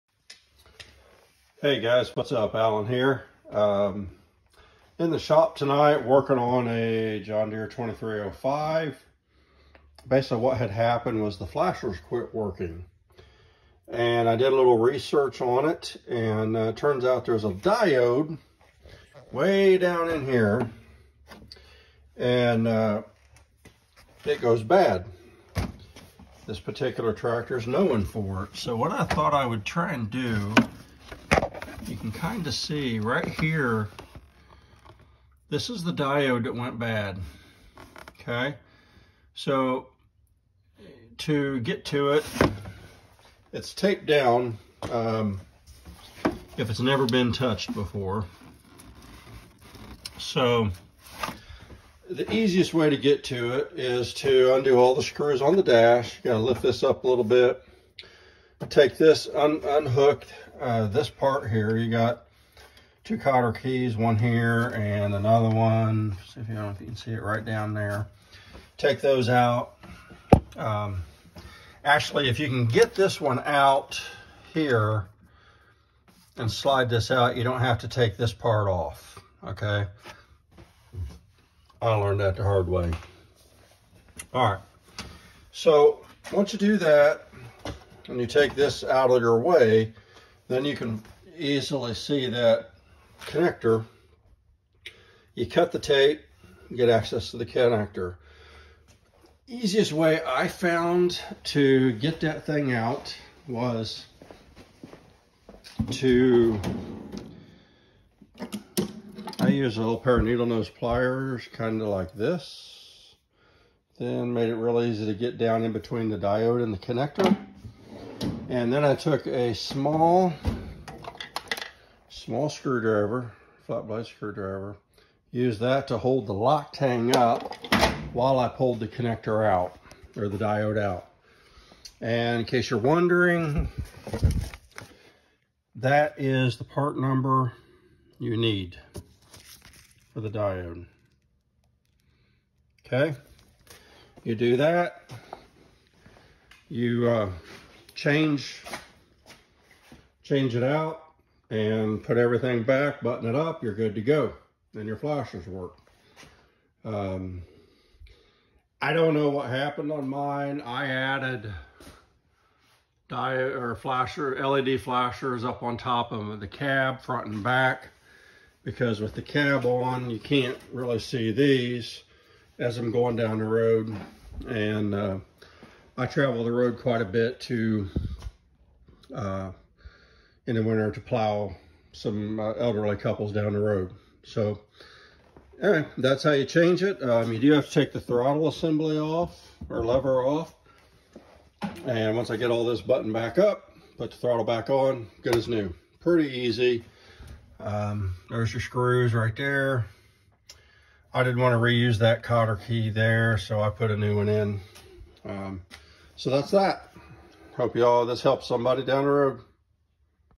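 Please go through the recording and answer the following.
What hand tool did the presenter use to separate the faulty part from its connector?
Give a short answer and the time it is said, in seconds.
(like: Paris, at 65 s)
Needle nose pliers, at 110 s.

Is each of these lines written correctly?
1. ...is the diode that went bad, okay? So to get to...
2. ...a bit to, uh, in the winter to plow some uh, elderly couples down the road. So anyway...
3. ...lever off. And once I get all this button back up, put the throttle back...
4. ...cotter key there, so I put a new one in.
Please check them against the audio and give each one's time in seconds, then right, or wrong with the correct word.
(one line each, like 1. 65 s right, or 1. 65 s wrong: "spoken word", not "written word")
1. 35 s right
2. 177 s right
3. 189 s right
4. 202 s right.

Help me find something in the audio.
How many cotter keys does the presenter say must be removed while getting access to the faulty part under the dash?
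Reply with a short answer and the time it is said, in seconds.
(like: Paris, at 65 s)
2, at 63 s.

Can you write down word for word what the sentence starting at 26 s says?
This particular tractor is known for it.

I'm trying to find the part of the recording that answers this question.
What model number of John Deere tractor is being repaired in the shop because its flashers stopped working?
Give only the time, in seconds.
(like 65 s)
7 s.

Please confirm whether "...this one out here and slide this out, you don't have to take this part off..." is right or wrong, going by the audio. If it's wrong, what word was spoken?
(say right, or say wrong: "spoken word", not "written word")
right.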